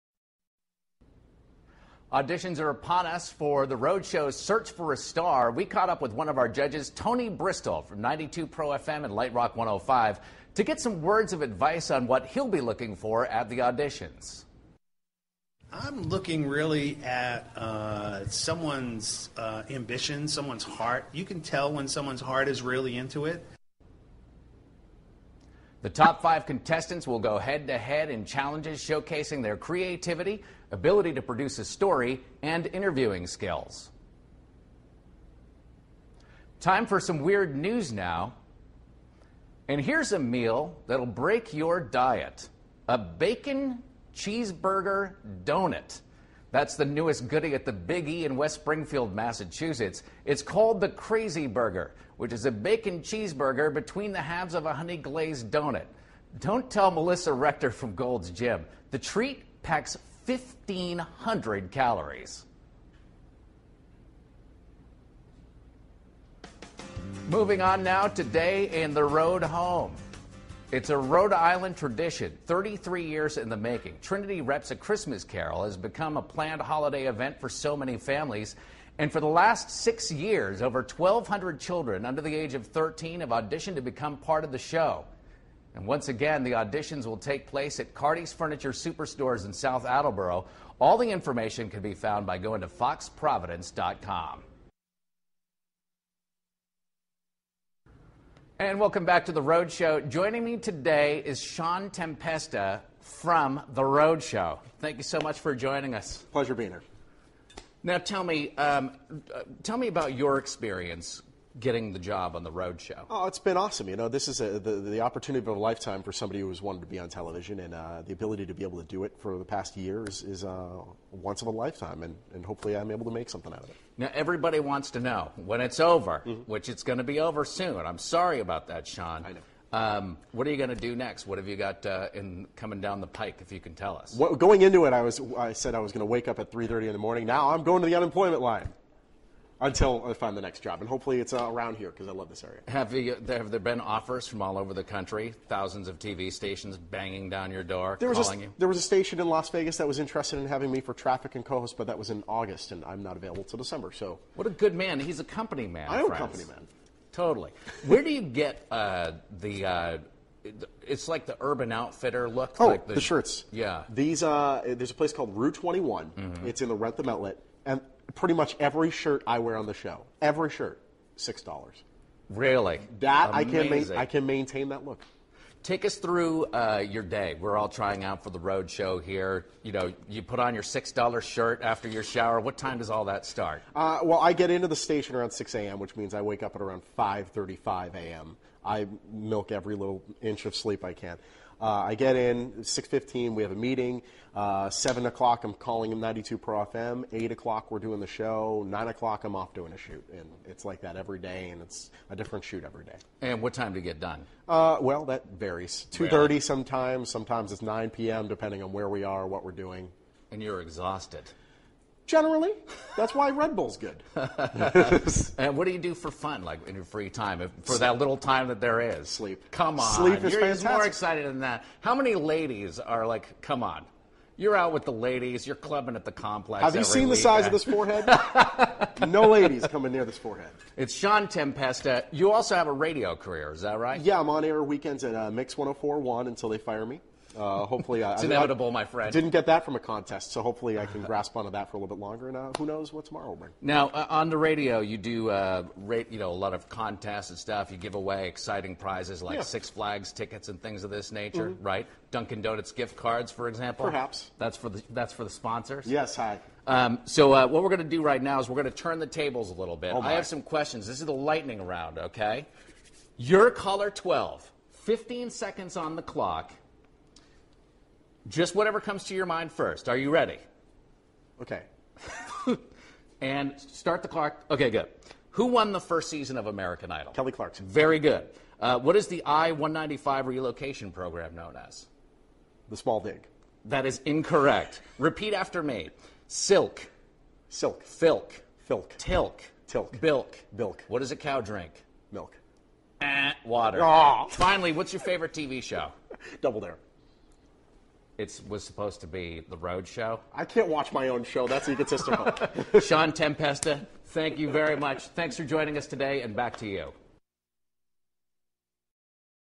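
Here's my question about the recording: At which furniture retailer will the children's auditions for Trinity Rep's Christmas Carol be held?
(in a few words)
Cardi's Furniture.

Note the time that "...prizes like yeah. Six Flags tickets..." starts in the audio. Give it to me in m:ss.
4:08.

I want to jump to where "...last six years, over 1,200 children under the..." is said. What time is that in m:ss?
1:19.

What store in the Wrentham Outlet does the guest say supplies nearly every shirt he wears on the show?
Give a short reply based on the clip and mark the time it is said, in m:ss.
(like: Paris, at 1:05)
Rue 21, at 2:45.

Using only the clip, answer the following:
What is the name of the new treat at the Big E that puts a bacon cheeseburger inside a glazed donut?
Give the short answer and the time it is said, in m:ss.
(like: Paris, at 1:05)
Crazy Burger, at 0:50.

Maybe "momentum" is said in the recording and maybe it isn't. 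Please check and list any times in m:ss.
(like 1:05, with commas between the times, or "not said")
not said.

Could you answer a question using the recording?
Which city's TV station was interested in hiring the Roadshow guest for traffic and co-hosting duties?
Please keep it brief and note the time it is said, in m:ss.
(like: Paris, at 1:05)
Las Vegas, at 2:29.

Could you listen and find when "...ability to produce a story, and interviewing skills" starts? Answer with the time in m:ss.
0:30.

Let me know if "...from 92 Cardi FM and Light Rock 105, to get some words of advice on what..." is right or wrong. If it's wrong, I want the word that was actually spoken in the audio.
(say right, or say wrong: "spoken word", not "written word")
wrong: "Pro", not "Cardi".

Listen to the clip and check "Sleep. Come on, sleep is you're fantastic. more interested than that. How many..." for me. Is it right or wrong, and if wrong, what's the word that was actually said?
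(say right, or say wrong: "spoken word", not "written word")
wrong: "excited", not "interested".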